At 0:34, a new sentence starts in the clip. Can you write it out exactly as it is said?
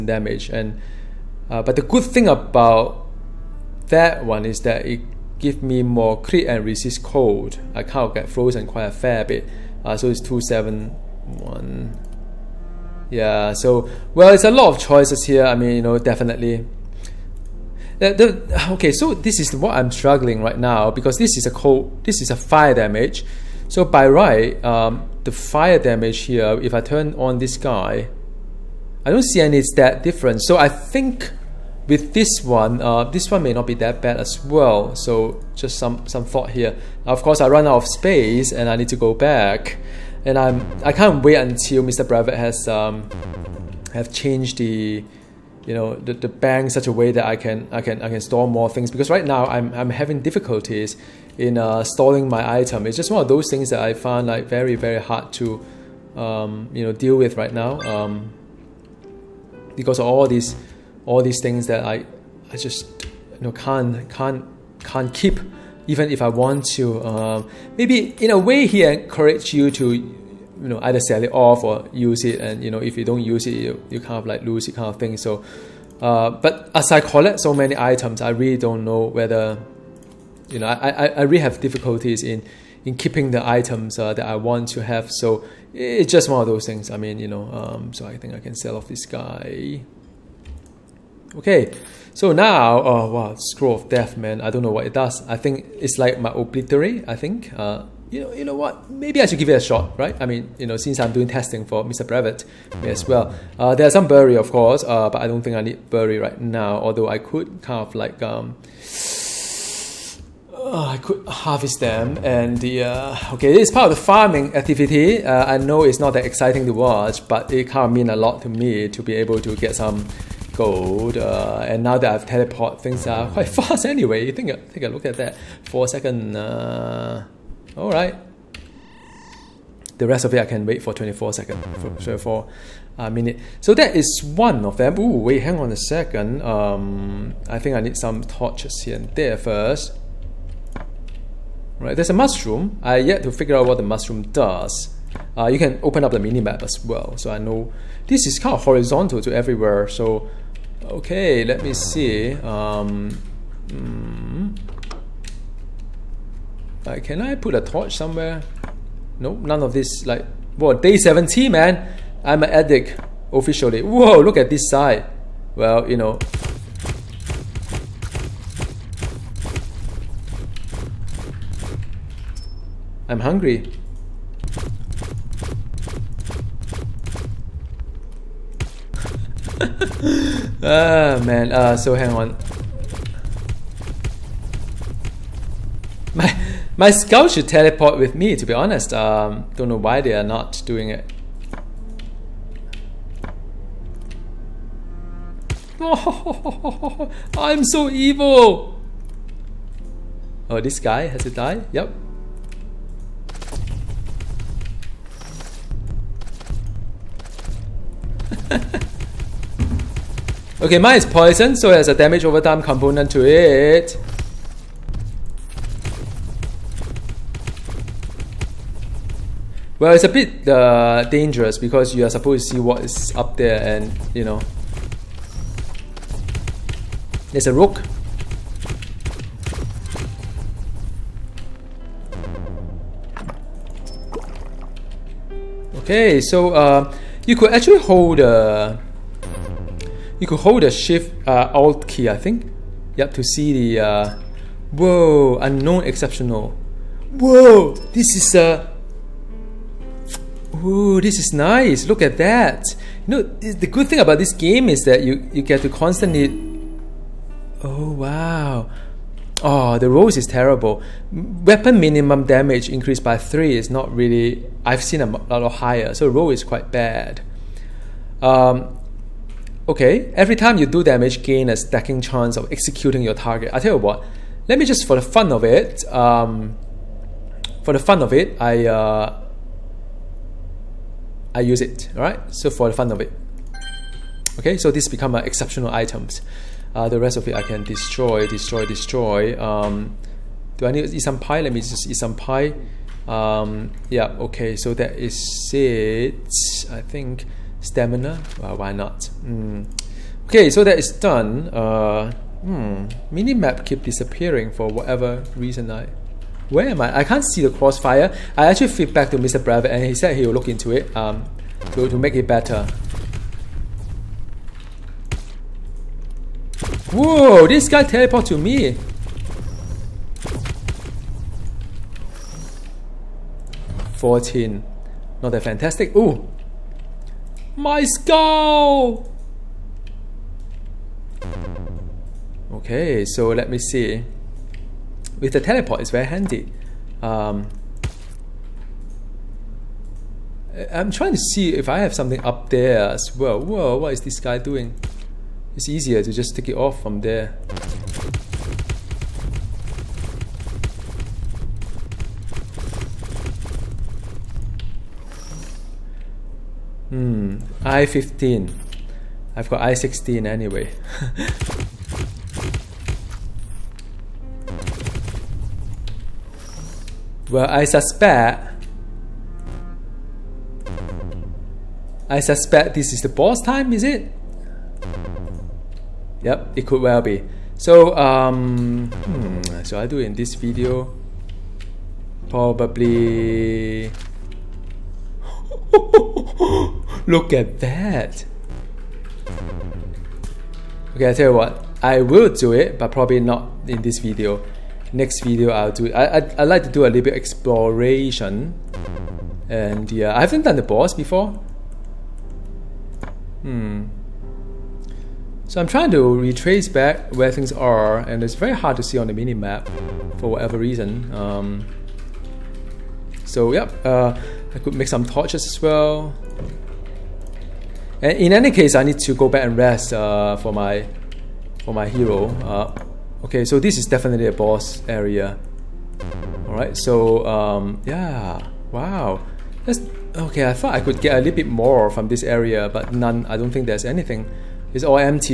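So just some, some thought here.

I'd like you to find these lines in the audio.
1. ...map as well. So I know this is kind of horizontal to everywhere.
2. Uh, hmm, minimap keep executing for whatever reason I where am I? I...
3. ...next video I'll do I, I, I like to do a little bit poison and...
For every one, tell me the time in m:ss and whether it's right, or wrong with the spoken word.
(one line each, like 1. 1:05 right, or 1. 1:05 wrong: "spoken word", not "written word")
1. 2:26 right
2. 5:01 wrong: "disappearing", not "executing"
3. 6:34 wrong: "exploration", not "poison".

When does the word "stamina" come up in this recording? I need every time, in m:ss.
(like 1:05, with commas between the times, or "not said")
4:57.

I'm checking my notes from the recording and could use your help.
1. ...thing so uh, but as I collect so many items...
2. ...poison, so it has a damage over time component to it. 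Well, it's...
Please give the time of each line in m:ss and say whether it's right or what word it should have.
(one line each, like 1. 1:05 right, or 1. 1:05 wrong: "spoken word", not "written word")
1. 1:14 right
2. 3:31 right.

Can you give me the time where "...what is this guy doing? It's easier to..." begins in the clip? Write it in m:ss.
5:43.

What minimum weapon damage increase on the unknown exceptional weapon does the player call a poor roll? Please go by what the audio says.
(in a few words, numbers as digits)
3.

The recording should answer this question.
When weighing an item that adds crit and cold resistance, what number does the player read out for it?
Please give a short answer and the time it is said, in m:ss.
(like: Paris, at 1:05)
271, at 0:10.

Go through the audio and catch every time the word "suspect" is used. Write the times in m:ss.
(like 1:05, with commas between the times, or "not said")
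6:07, 6:12.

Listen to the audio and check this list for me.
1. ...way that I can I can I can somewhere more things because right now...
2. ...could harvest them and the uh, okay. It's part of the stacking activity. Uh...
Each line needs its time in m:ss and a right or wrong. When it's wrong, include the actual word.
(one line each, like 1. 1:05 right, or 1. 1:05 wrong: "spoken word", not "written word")
1. 0:46 wrong: "store", not "somewhere"
2. 1:51 wrong: "farming", not "stacking".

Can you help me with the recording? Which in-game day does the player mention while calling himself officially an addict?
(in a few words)
17.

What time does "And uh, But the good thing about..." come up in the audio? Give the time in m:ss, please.
0:00.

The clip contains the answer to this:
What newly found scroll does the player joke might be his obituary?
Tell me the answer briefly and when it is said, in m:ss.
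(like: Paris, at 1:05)
Scroll of death, at 1:33.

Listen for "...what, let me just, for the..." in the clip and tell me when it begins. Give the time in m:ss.
4:33.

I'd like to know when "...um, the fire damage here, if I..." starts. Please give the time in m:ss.
0:24.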